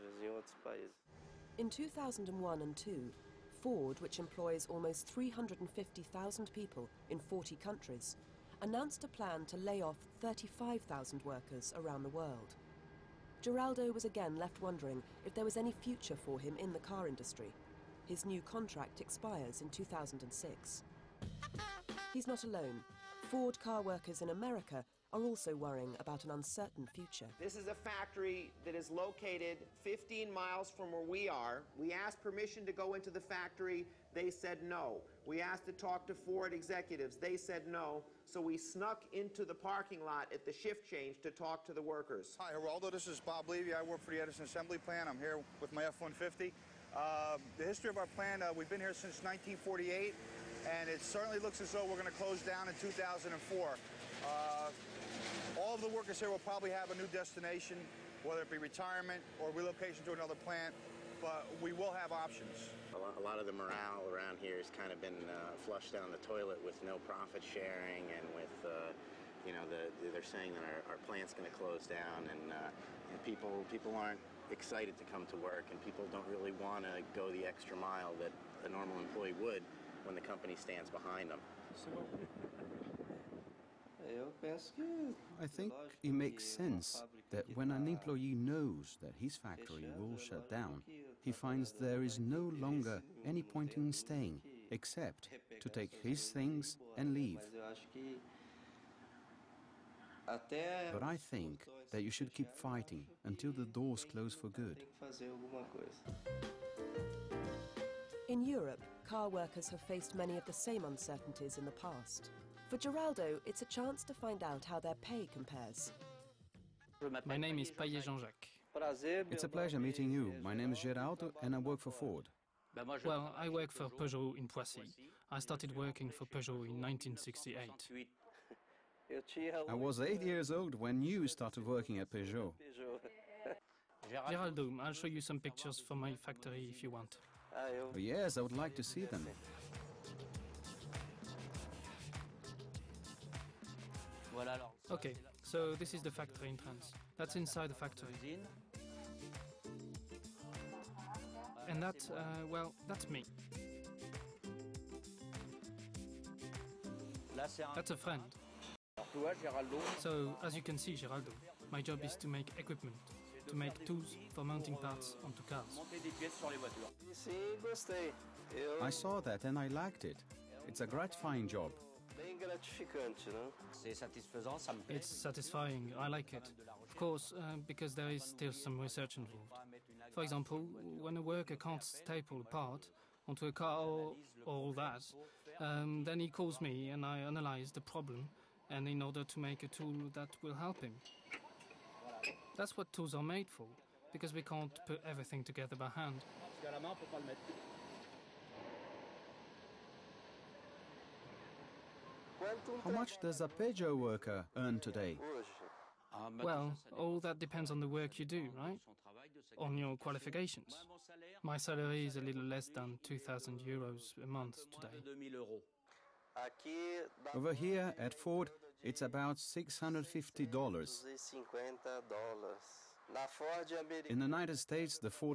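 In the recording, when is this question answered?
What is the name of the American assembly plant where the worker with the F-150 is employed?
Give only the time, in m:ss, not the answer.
0:44.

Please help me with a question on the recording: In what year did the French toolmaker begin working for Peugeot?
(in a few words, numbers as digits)
1968.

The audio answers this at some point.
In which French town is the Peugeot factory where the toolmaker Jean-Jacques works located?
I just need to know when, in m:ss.
2:04.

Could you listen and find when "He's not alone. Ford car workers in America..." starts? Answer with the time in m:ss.
0:22.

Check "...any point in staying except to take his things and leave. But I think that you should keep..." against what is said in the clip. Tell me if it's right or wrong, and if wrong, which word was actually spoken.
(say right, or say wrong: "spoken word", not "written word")
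right.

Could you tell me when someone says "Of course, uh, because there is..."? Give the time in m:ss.
2:56.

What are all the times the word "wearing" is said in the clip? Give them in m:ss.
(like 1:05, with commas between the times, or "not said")
not said.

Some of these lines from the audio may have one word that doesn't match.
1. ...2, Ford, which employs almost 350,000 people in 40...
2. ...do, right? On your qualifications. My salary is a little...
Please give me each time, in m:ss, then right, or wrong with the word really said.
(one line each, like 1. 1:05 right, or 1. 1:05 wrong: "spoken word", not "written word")
1. 0:02 right
2. 3:28 right.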